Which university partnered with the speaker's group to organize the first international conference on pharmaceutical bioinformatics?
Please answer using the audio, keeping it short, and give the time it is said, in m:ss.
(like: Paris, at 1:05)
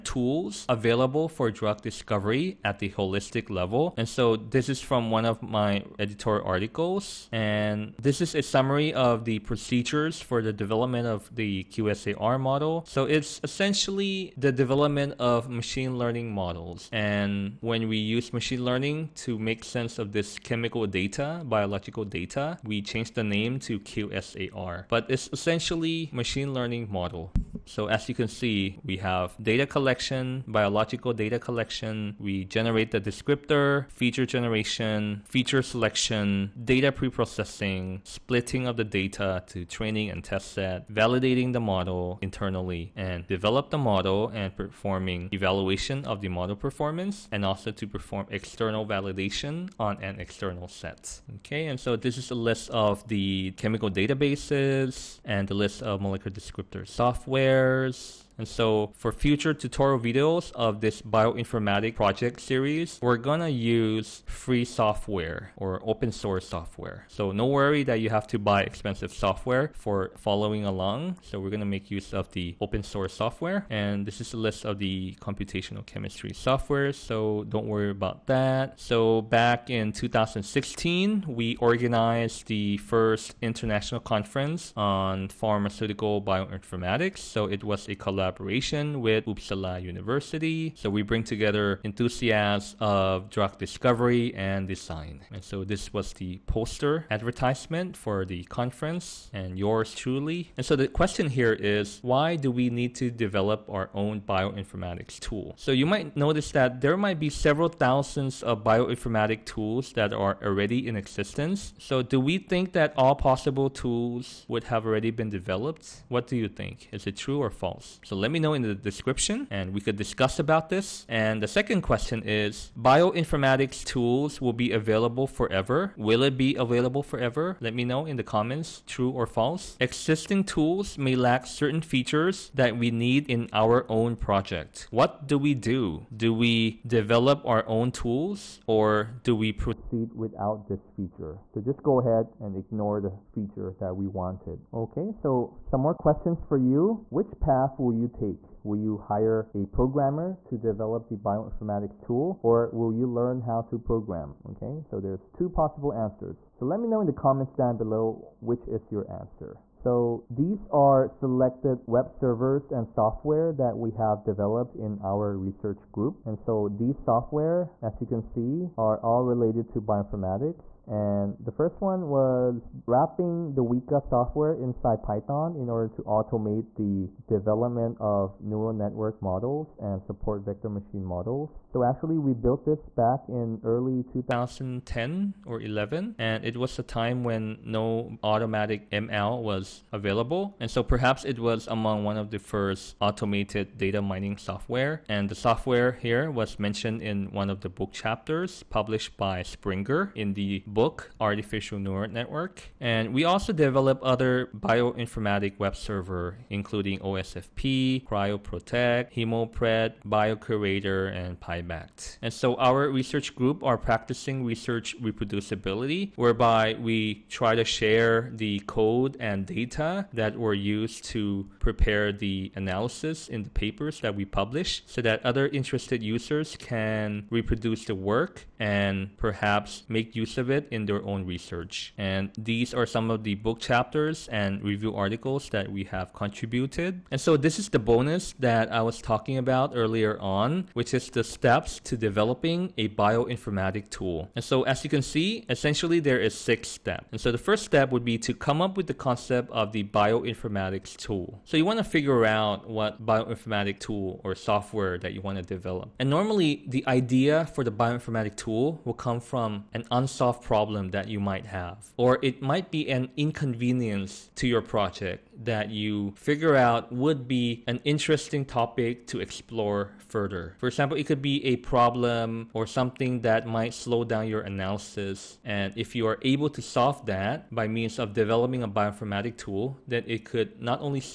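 Uppsala University, at 1:29.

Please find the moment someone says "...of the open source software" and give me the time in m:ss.
1:12.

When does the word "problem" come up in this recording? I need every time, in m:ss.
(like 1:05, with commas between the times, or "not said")
4:20, 4:31.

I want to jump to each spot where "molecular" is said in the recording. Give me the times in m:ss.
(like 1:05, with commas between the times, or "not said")
0:56.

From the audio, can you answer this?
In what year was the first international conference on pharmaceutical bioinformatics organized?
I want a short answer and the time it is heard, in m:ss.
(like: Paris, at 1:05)
2016, at 1:19.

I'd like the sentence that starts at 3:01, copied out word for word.
So actually we built this back in early 2010 or 11 and it was a time when no automatic ML was available.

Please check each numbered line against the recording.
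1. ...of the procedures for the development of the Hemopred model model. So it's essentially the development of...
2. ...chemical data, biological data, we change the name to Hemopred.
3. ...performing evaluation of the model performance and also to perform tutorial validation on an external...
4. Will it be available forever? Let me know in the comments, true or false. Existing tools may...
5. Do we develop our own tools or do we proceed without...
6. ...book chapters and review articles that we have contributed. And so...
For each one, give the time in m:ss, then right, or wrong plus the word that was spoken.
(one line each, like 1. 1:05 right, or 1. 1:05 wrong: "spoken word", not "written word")
1. 0:08 wrong: "QSAR", not "Hemopred"
2. 0:20 wrong: "QSAR", not "Hemopred"
3. 0:44 wrong: "external", not "tutorial"
4. 2:05 right
5. 2:16 right
6. 3:53 right.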